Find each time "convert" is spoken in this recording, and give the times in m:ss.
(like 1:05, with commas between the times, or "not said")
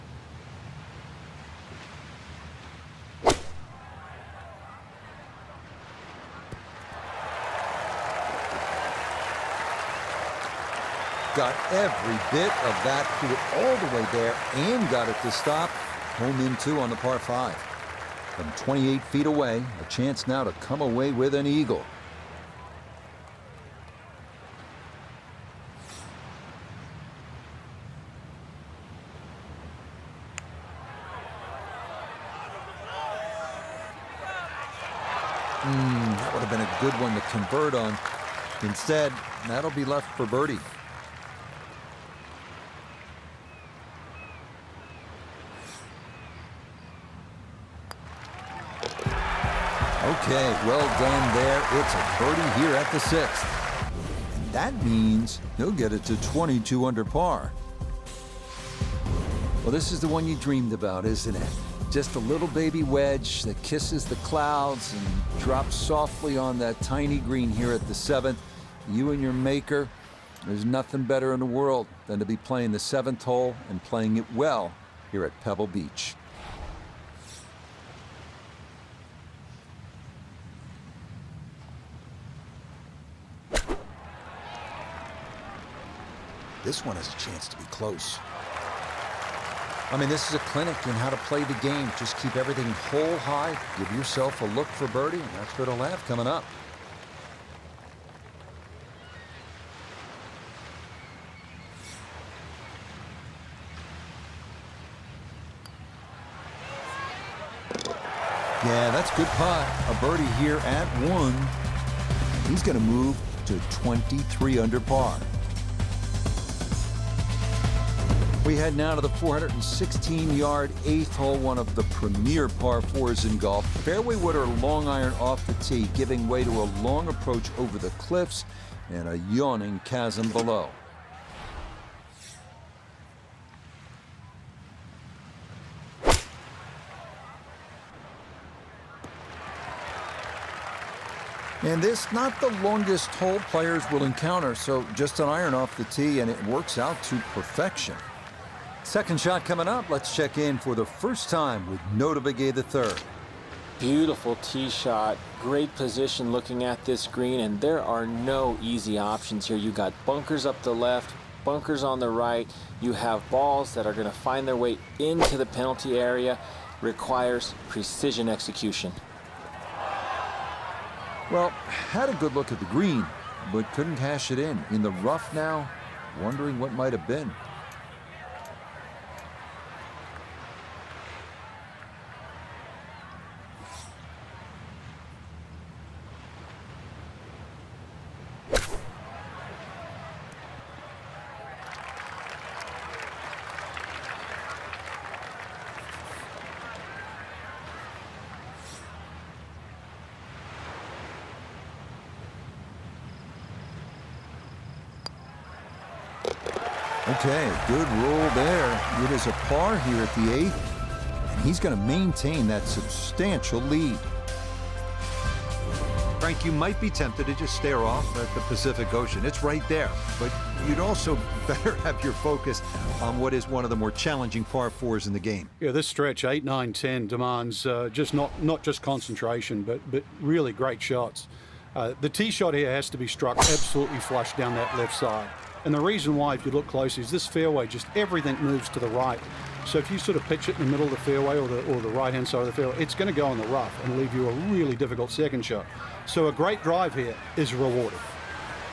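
0:37.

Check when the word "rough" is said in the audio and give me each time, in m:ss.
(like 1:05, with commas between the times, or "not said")
2:55, 4:03.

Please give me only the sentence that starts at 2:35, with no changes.
Great position looking at this green, and there are no easy options here.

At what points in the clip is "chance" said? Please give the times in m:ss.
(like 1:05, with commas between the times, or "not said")
0:19, 1:27.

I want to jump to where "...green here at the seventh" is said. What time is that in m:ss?
1:07.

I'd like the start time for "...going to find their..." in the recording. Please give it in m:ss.
2:43.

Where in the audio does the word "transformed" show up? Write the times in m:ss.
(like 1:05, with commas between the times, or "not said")
not said.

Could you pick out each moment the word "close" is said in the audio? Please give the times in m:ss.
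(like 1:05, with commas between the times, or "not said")
1:27, 3:56.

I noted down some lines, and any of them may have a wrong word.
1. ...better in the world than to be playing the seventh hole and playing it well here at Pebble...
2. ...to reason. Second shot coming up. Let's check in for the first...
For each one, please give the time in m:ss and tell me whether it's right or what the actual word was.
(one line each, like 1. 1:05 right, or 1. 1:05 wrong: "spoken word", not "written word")
1. 1:11 right
2. 2:27 wrong: "perfection", not "reason".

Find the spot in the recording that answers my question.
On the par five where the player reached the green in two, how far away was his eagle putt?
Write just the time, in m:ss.
0:18.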